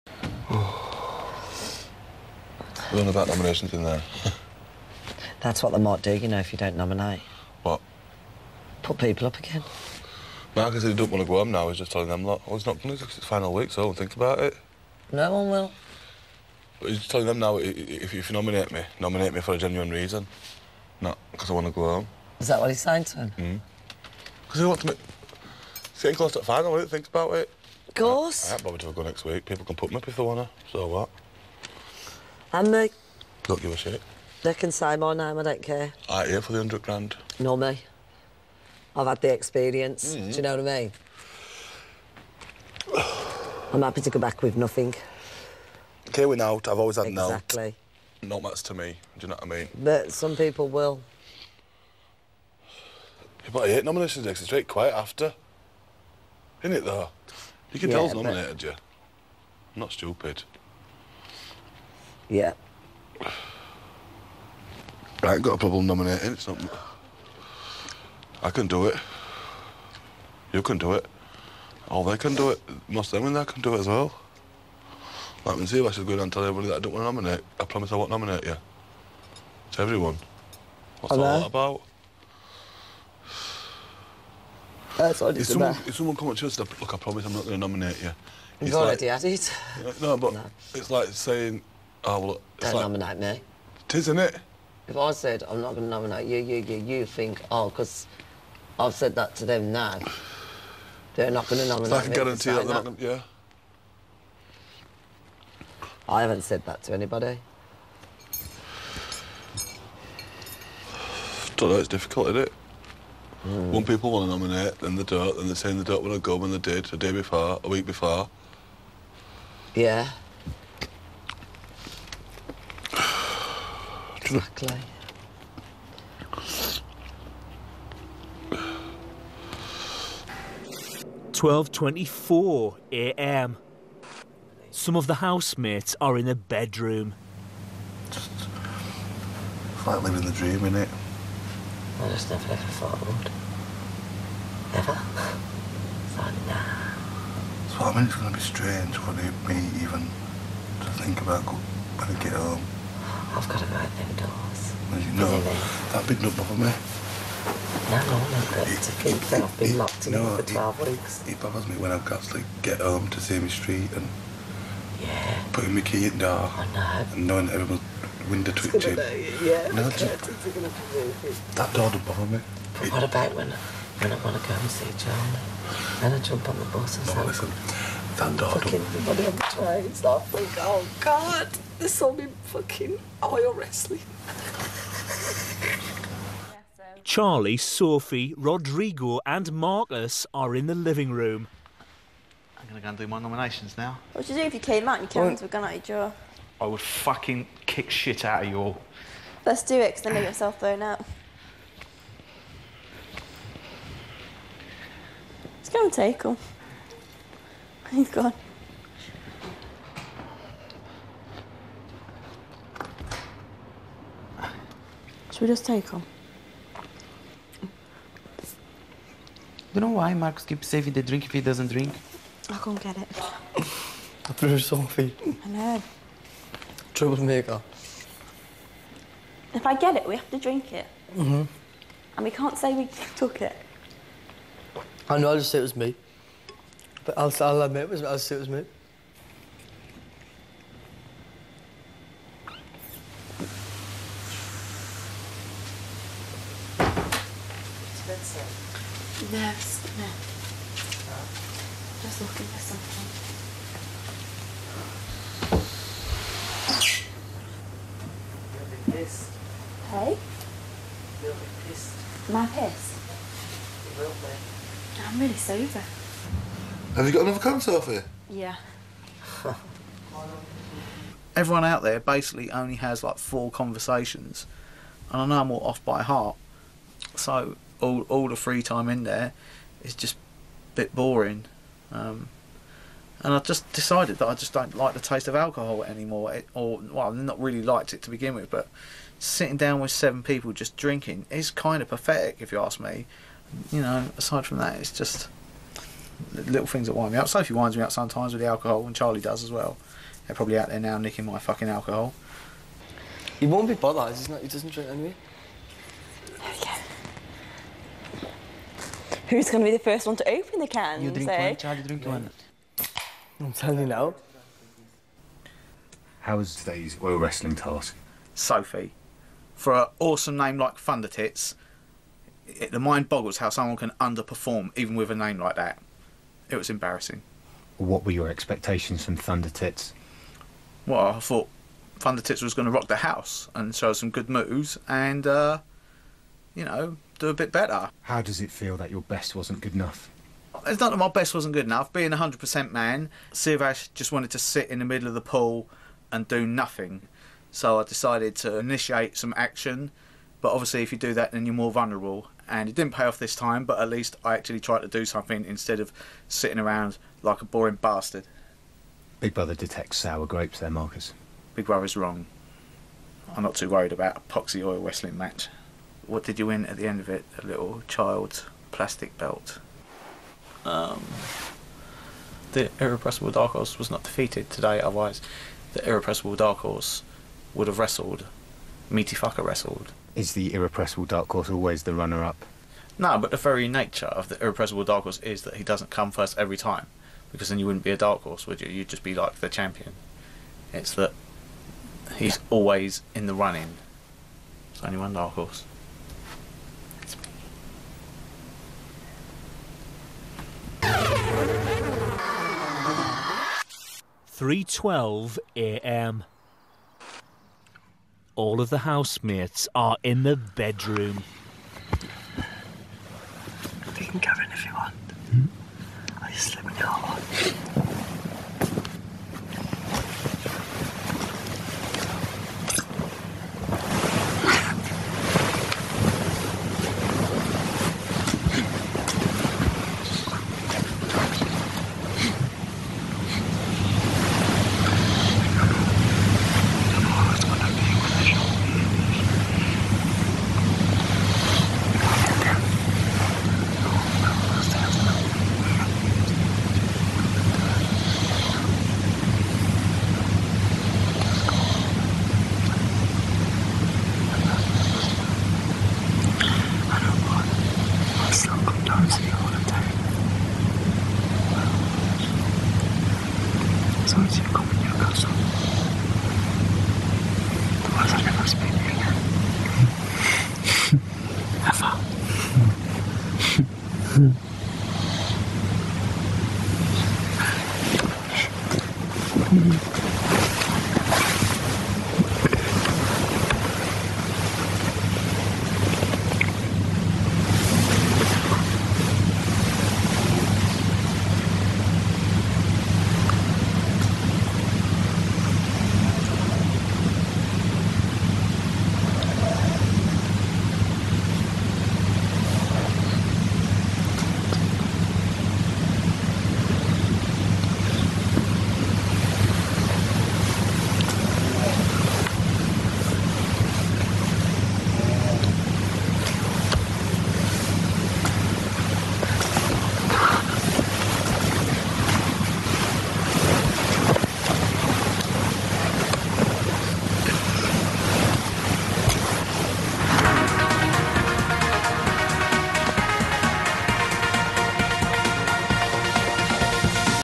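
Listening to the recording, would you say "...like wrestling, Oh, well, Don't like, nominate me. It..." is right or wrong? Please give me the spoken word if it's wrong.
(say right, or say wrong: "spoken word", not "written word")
wrong: "saying", not "wrestling".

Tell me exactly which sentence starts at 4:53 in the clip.
You know, aside from that, it's just little things that wind me up.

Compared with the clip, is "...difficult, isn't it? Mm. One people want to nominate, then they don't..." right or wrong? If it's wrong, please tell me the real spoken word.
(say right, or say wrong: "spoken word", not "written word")
right.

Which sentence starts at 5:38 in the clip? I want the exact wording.
How does it feel that your best wasn't good enough?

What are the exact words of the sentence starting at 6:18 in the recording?
Meaty Fucker wrestled is the irrepressible dark horse always the runner up?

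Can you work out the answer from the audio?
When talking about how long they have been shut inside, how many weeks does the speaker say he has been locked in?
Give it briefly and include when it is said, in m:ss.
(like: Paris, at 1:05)
12, at 2:40.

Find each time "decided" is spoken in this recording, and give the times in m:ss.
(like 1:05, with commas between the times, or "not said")
4:43, 5:47.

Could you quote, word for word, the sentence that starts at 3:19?
Let's do it, because then you get yourself thrown out.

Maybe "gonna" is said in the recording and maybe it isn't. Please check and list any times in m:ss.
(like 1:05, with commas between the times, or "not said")
2:48, 3:12, 3:25.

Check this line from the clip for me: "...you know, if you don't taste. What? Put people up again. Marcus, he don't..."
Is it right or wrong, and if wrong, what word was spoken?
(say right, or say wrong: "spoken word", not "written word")
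wrong: "nominate", not "taste".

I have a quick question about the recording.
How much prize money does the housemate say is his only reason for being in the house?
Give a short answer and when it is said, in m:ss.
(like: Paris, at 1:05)
100 grand, at 0:36.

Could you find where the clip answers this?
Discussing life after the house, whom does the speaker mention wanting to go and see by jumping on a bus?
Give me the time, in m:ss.
2:55.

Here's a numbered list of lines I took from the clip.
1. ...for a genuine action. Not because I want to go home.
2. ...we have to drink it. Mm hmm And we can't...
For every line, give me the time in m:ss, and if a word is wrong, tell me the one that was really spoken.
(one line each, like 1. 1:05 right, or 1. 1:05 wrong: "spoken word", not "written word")
1. 0:19 wrong: "reason", not "action"
2. 3:50 right.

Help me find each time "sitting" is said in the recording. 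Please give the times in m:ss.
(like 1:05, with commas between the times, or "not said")
4:49, 5:56.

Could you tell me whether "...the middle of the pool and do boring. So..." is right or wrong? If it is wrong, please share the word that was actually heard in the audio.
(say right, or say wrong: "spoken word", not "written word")
wrong: "nothing", not "boring".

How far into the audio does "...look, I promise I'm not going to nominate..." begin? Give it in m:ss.
1:26.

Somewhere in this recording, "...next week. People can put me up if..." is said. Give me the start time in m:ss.
0:29.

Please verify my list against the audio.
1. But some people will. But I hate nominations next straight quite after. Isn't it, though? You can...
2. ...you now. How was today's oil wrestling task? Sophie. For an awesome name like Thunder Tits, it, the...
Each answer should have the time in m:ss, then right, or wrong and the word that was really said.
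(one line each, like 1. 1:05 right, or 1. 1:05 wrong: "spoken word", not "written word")
1. 0:49 right
2. 5:13 right.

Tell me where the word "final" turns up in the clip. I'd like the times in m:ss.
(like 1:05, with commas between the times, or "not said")
0:13, 0:26.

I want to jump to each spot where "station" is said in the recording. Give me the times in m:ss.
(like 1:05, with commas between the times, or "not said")
not said.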